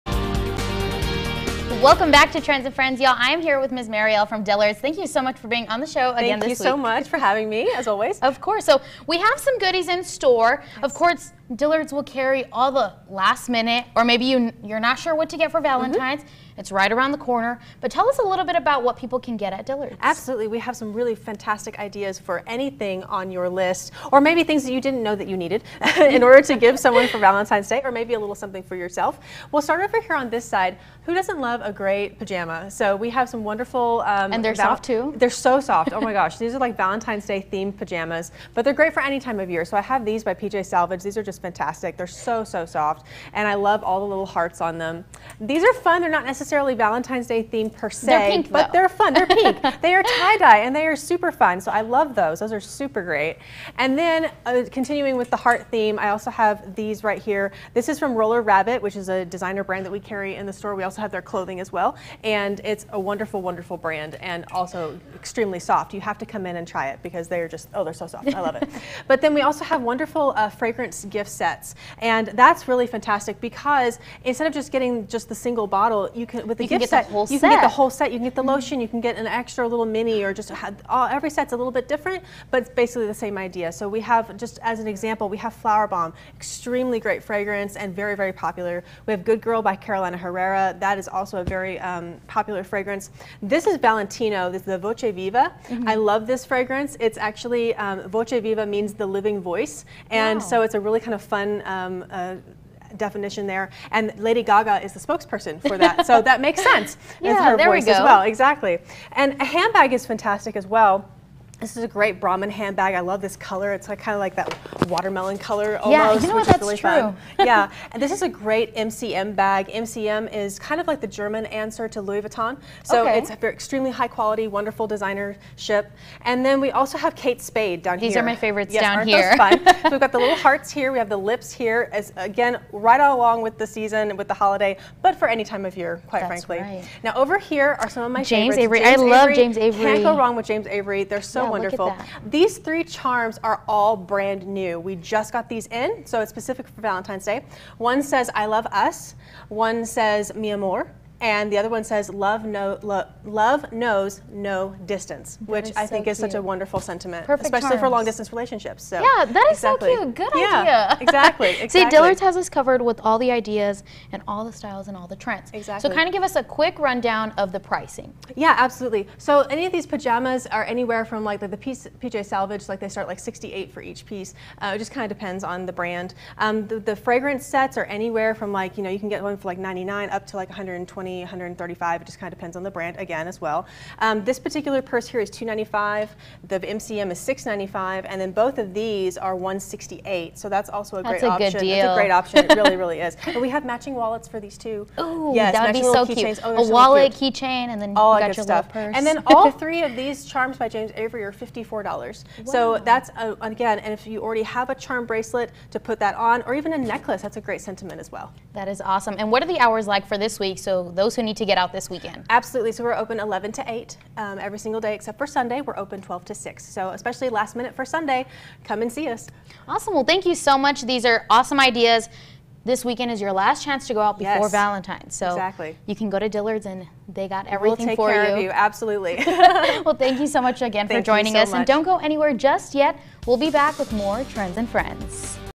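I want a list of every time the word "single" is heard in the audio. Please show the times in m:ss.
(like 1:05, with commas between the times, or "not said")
1:15, 3:34.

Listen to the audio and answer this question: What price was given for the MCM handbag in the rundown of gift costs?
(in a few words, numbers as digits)
$695.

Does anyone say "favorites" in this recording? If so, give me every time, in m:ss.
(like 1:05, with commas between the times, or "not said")
2:08, 2:18.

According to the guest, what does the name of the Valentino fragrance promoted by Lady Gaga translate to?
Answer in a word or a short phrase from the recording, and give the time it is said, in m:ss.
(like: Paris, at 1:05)
the living voice, at 1:39.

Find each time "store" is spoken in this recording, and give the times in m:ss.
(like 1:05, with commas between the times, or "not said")
0:10, 1:00.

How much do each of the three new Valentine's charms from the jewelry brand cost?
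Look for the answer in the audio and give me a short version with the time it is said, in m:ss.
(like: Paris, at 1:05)
$54, at 3:21.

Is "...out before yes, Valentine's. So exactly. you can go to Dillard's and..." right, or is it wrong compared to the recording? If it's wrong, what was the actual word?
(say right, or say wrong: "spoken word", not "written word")
right.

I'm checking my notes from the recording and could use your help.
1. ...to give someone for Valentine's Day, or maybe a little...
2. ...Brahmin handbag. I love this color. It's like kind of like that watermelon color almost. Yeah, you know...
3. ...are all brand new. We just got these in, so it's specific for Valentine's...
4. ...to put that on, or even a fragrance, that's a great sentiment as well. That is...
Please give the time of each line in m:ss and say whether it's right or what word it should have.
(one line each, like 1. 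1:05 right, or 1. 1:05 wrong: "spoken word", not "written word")
1. 0:26 right
2. 1:52 right
3. 2:23 right
4. 3:25 wrong: "necklace", not "fragrance".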